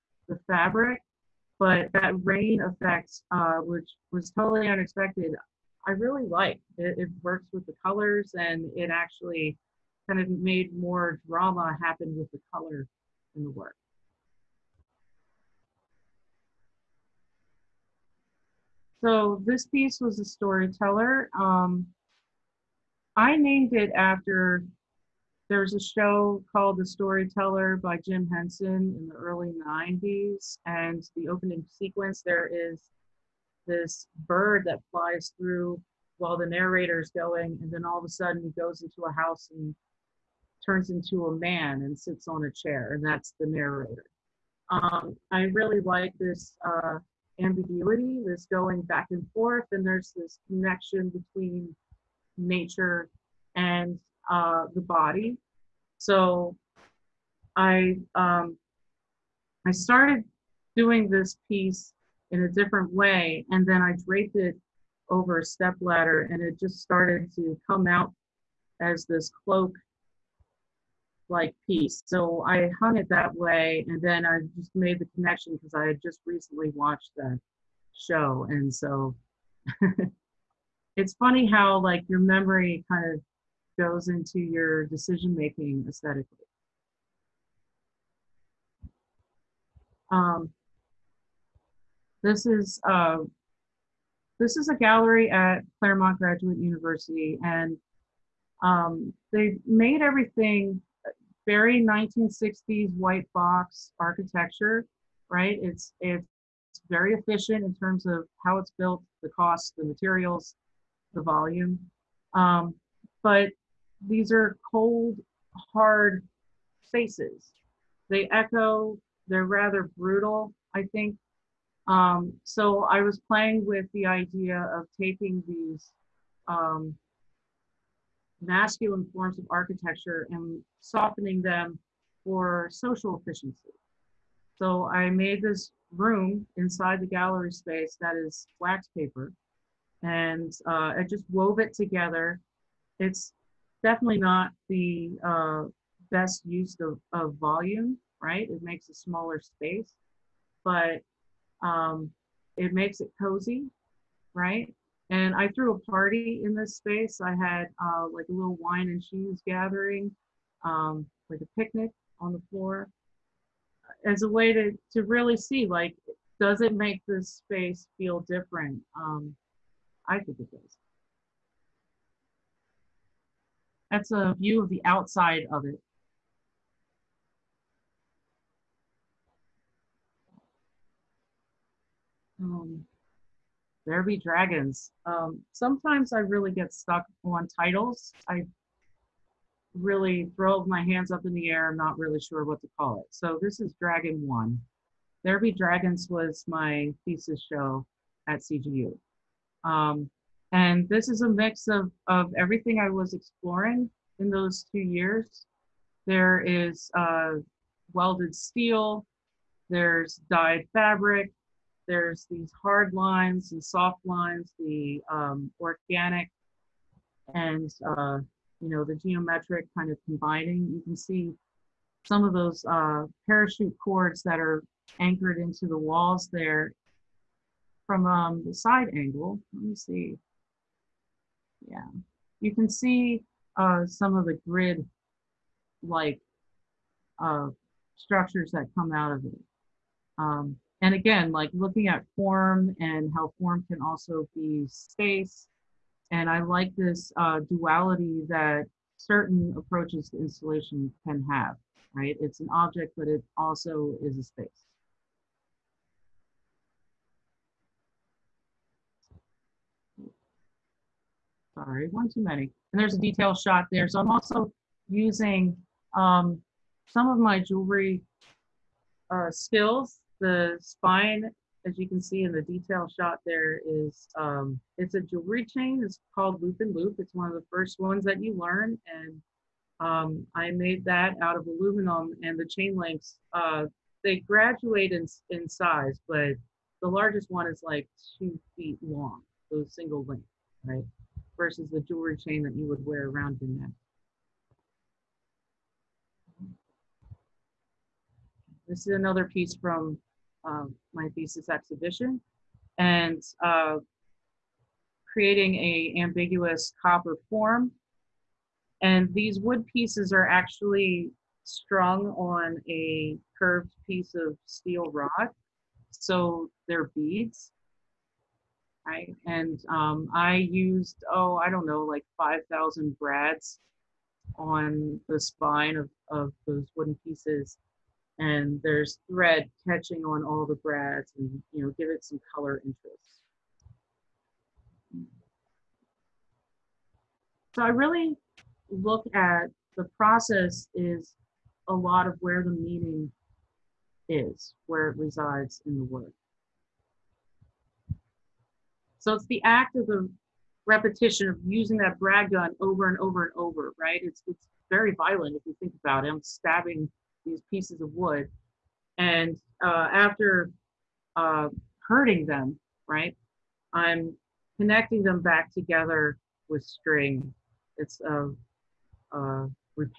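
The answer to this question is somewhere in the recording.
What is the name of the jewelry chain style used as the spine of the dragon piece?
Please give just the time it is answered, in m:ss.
4:36.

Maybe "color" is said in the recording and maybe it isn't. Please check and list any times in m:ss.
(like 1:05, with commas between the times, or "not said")
0:07, 0:12, 5:32.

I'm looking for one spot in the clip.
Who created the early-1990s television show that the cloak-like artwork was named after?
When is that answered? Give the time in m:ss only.
0:27.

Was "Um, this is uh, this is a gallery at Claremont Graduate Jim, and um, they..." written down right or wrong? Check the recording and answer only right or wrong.
wrong.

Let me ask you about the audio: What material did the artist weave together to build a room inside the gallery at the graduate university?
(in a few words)
wax paper.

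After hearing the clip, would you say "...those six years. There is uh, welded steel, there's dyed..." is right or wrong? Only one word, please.
wrong.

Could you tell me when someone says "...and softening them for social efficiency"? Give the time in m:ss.
2:10.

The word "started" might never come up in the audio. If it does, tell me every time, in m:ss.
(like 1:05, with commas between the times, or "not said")
0:59, 1:06.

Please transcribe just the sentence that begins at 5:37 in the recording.
So I really look at the process is a lot of where the meaning is, where it resides in the work.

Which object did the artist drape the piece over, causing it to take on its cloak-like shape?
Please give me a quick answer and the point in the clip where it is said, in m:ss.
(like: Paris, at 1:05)
step ladder, at 1:05.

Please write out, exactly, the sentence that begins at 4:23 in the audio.
So I'm also using um, some of my jewelry uh, skills.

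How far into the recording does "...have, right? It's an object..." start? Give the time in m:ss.
4:11.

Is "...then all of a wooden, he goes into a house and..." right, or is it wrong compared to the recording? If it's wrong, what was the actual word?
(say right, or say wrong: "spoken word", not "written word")
wrong: "sudden", not "wooden".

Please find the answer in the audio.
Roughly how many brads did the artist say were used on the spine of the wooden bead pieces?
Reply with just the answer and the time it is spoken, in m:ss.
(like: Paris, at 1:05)
5,000, at 5:22.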